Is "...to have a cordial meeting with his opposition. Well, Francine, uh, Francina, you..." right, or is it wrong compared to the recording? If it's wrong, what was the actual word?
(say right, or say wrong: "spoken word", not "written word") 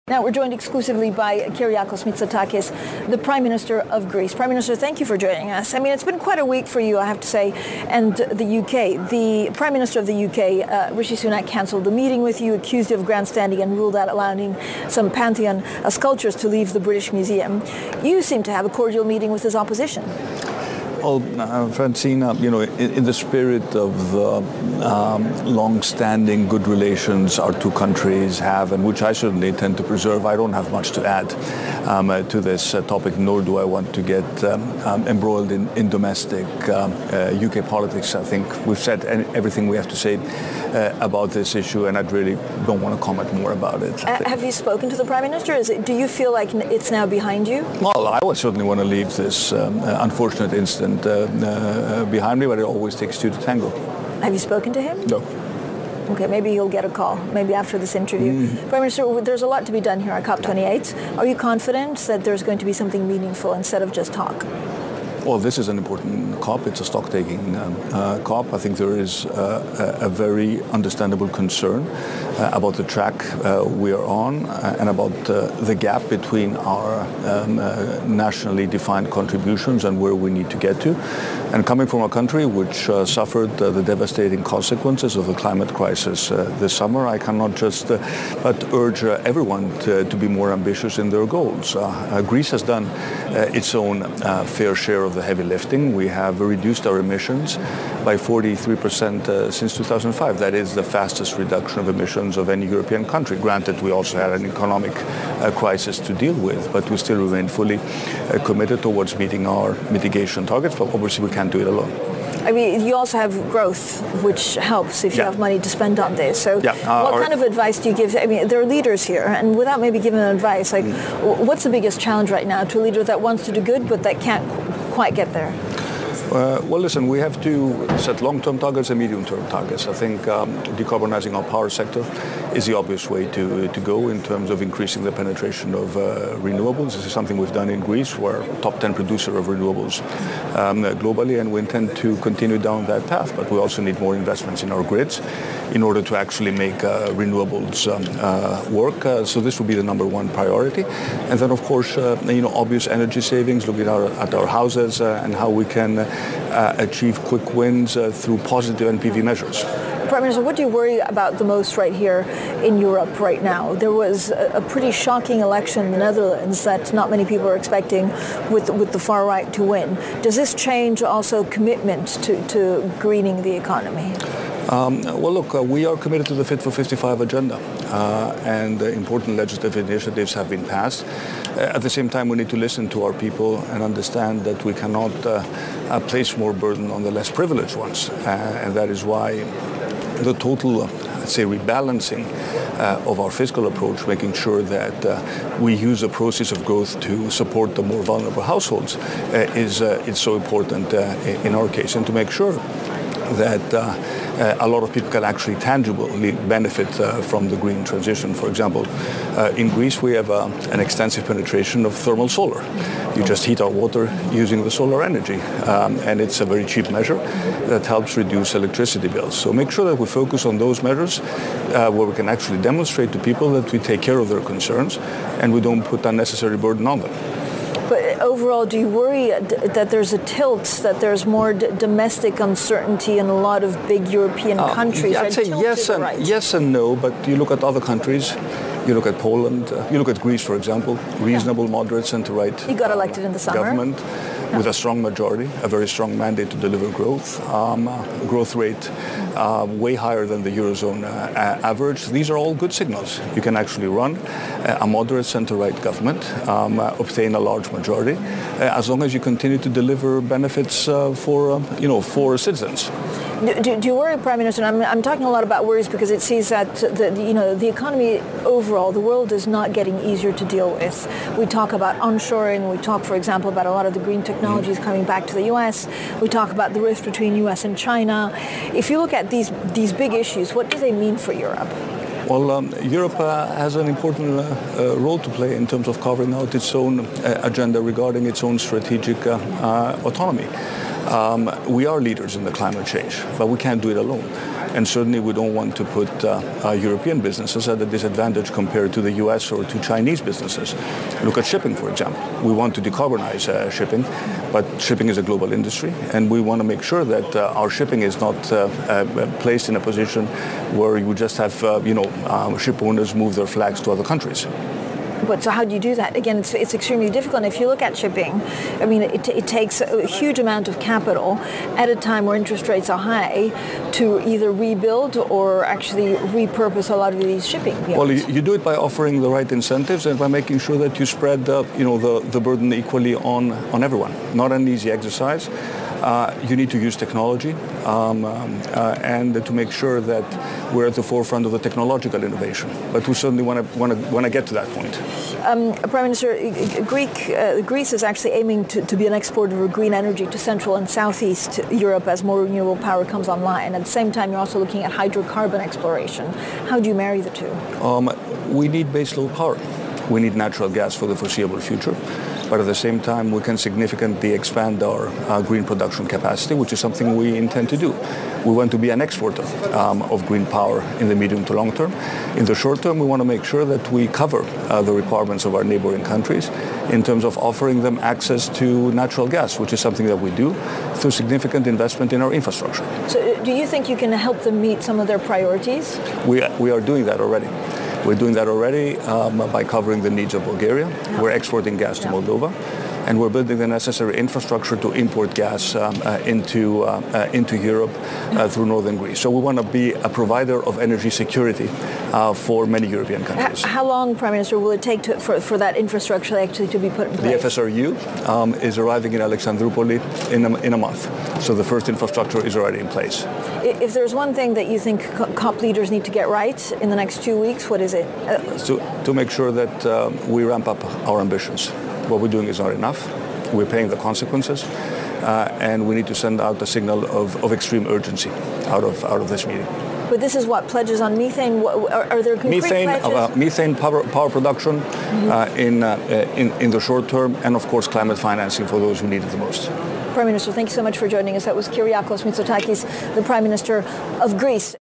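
right.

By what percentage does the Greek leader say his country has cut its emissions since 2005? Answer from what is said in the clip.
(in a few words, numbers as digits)
43%.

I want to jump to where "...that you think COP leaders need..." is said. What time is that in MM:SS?
06:54.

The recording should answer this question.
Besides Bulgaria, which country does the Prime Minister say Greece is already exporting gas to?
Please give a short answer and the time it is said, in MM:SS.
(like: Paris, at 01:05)
Moldova, at 06:32.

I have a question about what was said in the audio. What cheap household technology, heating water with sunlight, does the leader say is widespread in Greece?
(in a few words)
thermal solar.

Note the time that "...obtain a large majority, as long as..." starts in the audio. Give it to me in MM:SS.
04:16.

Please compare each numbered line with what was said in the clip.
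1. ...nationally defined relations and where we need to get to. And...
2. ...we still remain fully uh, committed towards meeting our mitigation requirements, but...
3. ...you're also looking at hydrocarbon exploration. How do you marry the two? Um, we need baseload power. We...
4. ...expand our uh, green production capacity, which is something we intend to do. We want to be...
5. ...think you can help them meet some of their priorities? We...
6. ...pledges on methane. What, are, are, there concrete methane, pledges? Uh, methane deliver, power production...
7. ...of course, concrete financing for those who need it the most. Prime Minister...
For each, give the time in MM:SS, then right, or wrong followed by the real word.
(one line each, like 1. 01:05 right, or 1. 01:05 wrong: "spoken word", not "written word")
1. 01:18 wrong: "contributions", not "relations"
2. 01:46 wrong: "targets", not "requirements"
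3. 05:54 right
4. 06:04 right
5. 06:23 right
6. 07:10 wrong: "power", not "deliver"
7. 07:17 wrong: "climate", not "concrete".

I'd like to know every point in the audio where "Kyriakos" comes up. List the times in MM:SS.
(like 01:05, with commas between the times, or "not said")
00:01, 07:21.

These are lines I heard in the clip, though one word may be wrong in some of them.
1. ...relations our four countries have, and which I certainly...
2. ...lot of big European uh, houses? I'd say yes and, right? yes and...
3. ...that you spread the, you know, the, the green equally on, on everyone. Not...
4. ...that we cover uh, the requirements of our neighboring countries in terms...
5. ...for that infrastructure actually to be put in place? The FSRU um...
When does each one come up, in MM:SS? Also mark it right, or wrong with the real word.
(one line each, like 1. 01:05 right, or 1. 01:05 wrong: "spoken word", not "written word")
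1. 00:26 wrong: "two", not "four"
2. 03:53 wrong: "countries", not "houses"
3. 05:30 wrong: "burden", not "green"
4. 06:13 right
5. 06:45 right.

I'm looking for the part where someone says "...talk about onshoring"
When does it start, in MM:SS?
04:31.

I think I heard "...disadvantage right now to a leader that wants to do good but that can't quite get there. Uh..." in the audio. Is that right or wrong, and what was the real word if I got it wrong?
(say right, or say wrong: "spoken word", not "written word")
wrong: "challenge", not "disadvantage".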